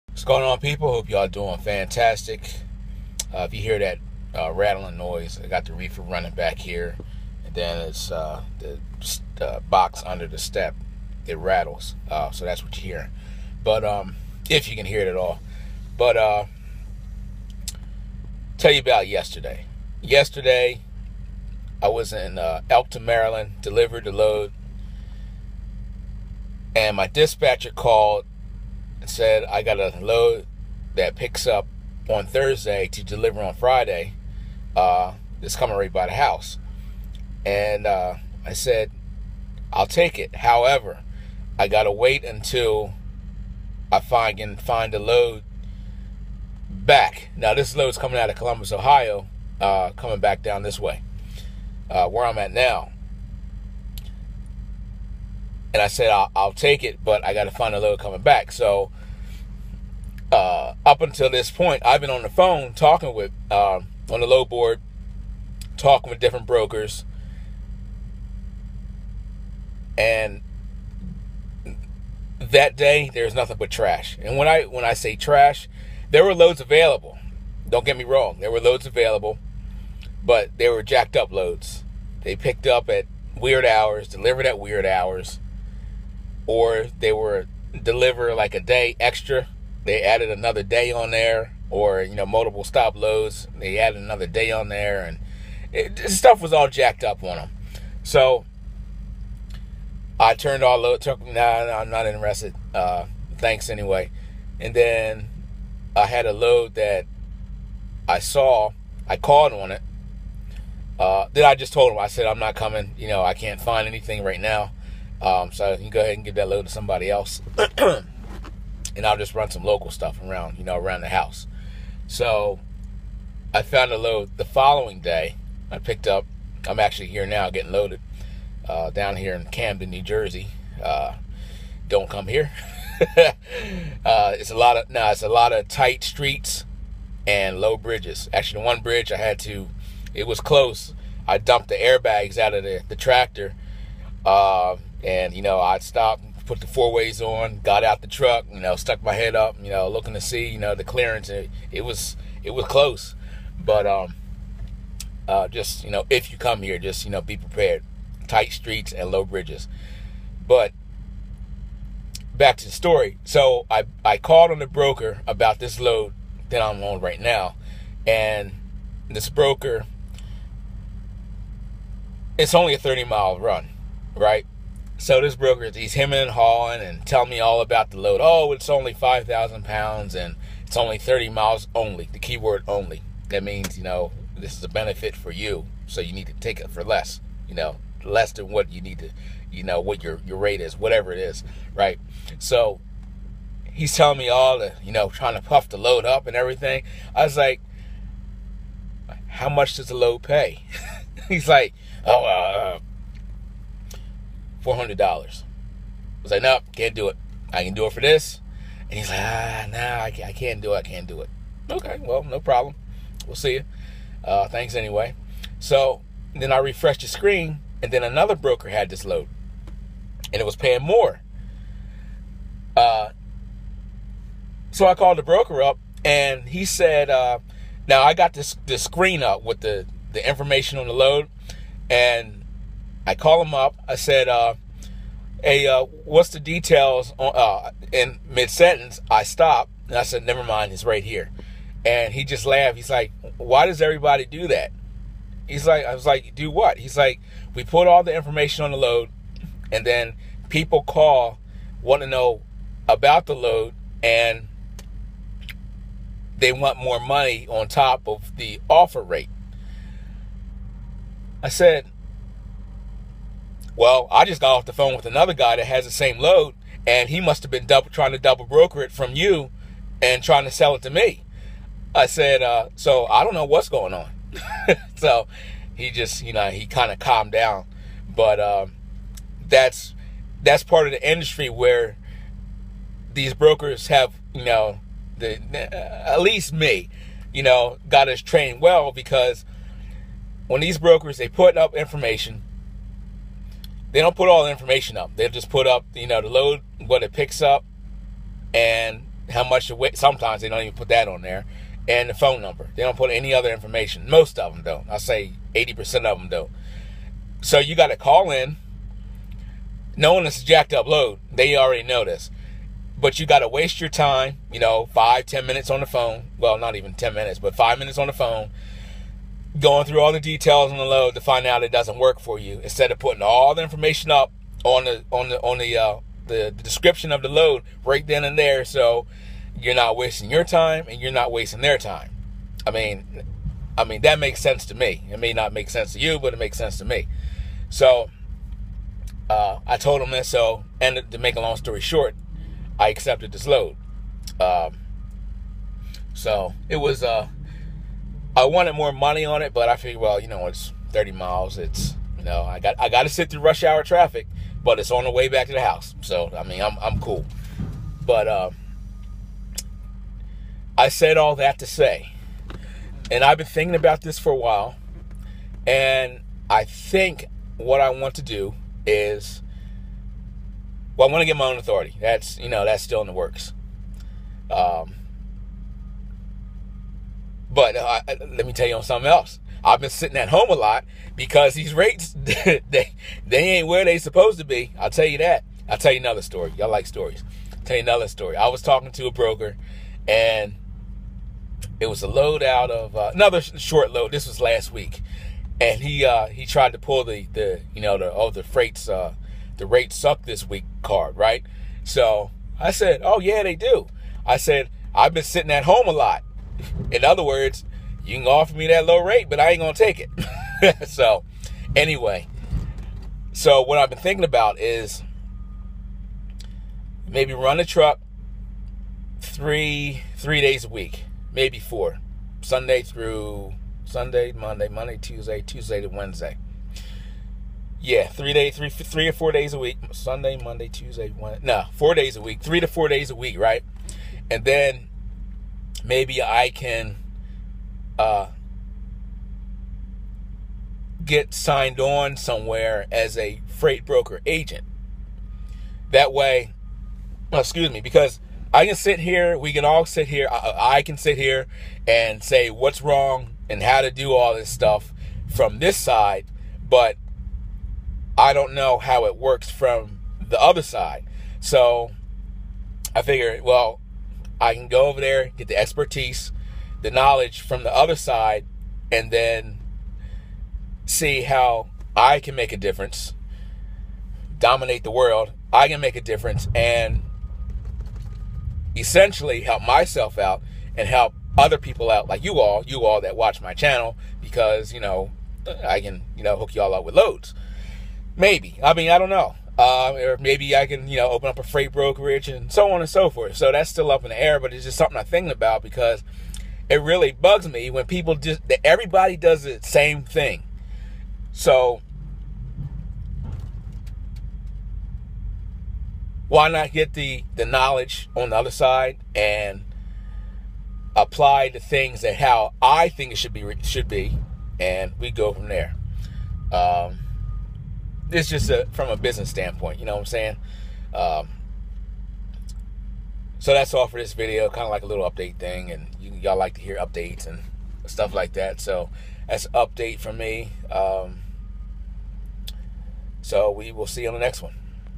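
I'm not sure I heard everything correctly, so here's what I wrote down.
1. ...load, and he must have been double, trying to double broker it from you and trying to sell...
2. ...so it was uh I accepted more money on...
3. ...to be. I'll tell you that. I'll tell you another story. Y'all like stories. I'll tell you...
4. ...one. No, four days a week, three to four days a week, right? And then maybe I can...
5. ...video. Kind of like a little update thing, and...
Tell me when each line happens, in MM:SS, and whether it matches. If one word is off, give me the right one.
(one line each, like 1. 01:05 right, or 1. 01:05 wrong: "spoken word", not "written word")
1. 04:26 right
2. 05:46 wrong: "wanted", not "accepted"
3. 06:24 right
4. 07:11 right
5. 08:44 right.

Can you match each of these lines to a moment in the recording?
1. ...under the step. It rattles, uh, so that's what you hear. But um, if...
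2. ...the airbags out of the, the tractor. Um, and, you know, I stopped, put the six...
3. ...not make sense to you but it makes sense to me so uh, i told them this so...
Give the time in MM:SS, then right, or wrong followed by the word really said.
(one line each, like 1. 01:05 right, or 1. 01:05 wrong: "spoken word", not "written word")
1. 00:10 right
2. 02:21 wrong: "four", not "six"
3. 05:35 right.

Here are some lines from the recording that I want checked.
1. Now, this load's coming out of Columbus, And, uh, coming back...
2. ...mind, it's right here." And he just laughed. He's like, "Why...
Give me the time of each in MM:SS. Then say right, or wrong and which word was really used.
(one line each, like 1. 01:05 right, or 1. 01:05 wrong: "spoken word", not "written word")
1. 00:47 wrong: "Ohio", not "And"
2. 04:00 right.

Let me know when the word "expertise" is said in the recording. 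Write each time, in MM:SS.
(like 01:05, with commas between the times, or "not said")
07:45.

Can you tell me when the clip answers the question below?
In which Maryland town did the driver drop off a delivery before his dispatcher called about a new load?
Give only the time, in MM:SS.
00:22.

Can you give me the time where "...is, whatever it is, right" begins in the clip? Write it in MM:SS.
03:10.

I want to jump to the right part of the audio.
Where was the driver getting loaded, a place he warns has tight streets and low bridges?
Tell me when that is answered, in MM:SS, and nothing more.
02:09.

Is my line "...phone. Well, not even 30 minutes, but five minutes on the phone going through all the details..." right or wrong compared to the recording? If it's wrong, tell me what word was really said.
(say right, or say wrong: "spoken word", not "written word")
wrong: "10", not "30".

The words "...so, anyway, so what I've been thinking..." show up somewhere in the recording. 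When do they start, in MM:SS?
06:50.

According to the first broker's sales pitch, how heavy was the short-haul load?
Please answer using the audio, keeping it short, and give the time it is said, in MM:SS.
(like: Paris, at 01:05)
5,000 pounds, at 02:58.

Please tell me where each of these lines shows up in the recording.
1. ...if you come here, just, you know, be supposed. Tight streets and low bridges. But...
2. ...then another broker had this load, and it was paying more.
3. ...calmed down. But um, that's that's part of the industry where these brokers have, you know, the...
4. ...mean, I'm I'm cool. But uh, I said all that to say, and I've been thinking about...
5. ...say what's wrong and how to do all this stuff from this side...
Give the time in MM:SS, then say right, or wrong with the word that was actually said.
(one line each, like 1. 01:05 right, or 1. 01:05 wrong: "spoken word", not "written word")
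1. 02:36 wrong: "prepared", not "supposed"
2. 03:37 right
3. 04:36 right
4. 05:56 right
5. 07:32 right.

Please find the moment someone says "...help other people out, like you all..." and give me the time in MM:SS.
08:00.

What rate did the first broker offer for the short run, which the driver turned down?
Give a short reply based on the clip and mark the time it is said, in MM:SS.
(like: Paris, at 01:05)
$400, at 03:24.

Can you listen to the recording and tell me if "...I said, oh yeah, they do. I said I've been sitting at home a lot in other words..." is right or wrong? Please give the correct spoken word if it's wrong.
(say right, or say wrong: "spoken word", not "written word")
right.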